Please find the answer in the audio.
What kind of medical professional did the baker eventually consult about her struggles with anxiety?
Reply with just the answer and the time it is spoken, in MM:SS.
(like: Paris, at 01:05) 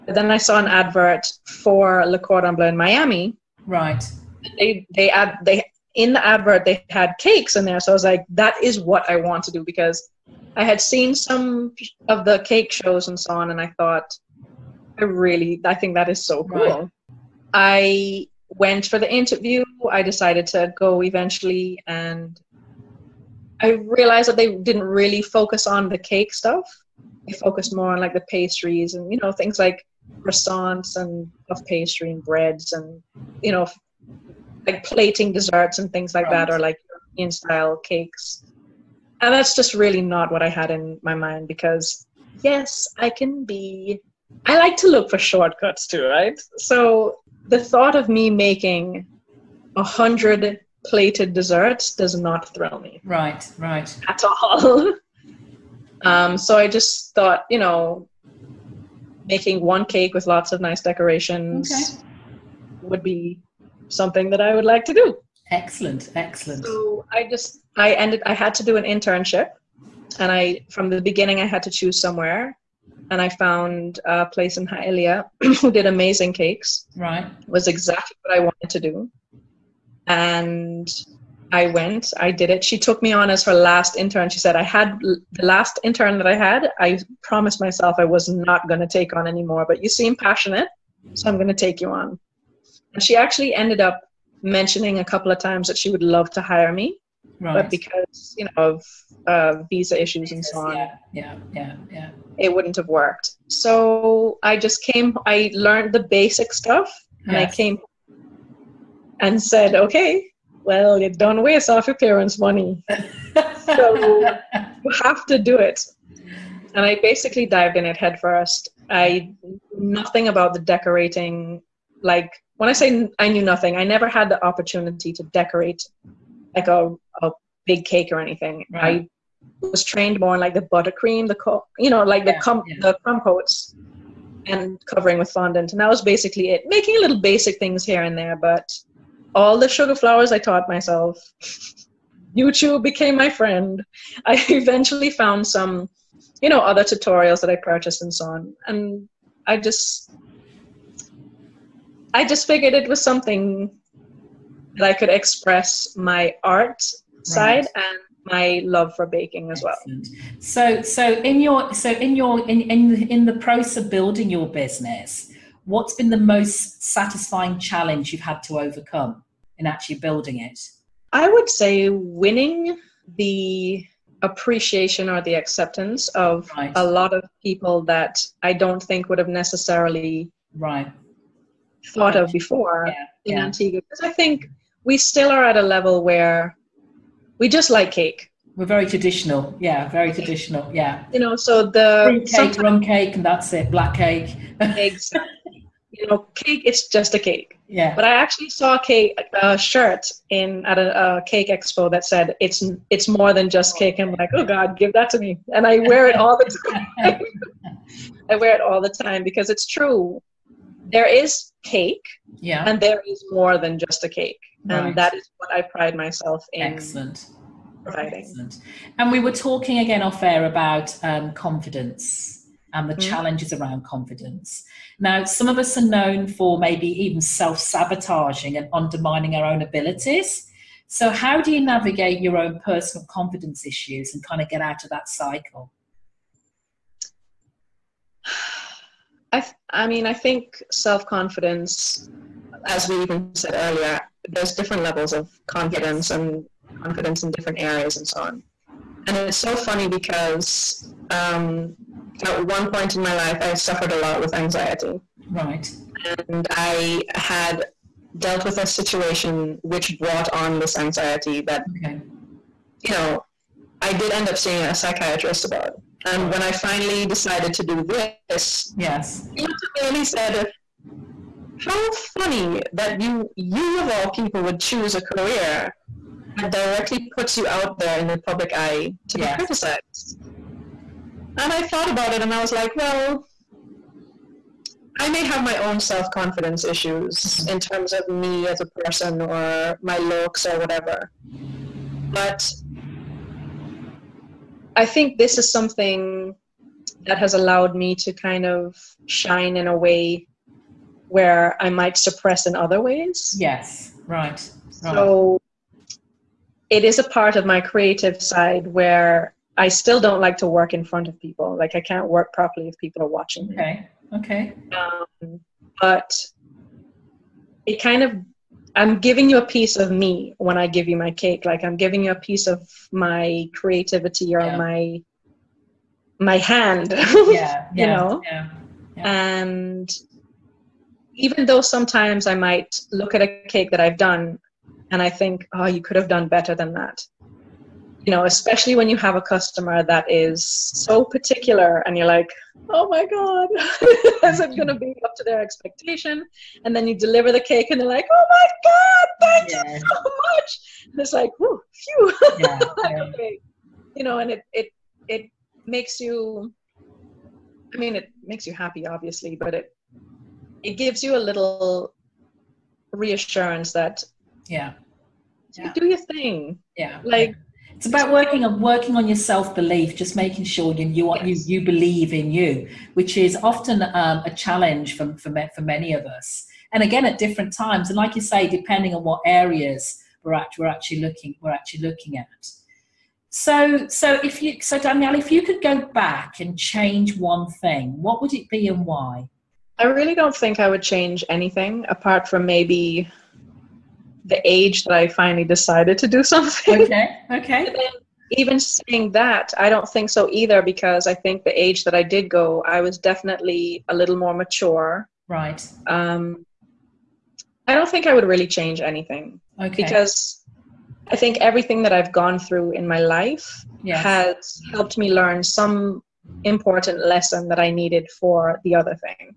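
A psychiatrist, at 04:24.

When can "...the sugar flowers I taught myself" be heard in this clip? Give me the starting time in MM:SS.
02:19.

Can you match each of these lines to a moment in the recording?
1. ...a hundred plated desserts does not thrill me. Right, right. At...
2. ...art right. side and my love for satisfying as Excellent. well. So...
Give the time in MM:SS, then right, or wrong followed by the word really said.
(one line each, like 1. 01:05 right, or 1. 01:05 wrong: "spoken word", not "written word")
1. 00:49 right
2. 02:36 wrong: "baking", not "satisfying".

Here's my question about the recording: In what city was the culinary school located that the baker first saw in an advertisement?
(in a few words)
Miami.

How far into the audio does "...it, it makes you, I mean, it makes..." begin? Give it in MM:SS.
05:54.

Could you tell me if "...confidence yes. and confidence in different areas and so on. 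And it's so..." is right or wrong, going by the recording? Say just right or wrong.
right.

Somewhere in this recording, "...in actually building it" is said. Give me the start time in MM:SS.
02:49.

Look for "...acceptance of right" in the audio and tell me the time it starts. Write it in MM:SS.
02:55.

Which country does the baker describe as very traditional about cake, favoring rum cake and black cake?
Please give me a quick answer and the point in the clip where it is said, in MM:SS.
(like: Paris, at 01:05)
Antigua, at 03:03.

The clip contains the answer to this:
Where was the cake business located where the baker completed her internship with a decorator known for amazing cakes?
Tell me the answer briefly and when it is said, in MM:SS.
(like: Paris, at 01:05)
Hialeah, at 01:14.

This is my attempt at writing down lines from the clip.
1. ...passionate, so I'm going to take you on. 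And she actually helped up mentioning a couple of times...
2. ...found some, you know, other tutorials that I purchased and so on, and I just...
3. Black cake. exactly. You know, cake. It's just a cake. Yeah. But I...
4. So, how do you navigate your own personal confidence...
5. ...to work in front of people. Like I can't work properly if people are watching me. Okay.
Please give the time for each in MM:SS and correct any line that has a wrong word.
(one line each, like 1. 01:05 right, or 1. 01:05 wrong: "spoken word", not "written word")
1. 01:30 wrong: "ended", not "helped"
2. 02:25 right
3. 03:13 right
4. 03:50 right
5. 05:10 right.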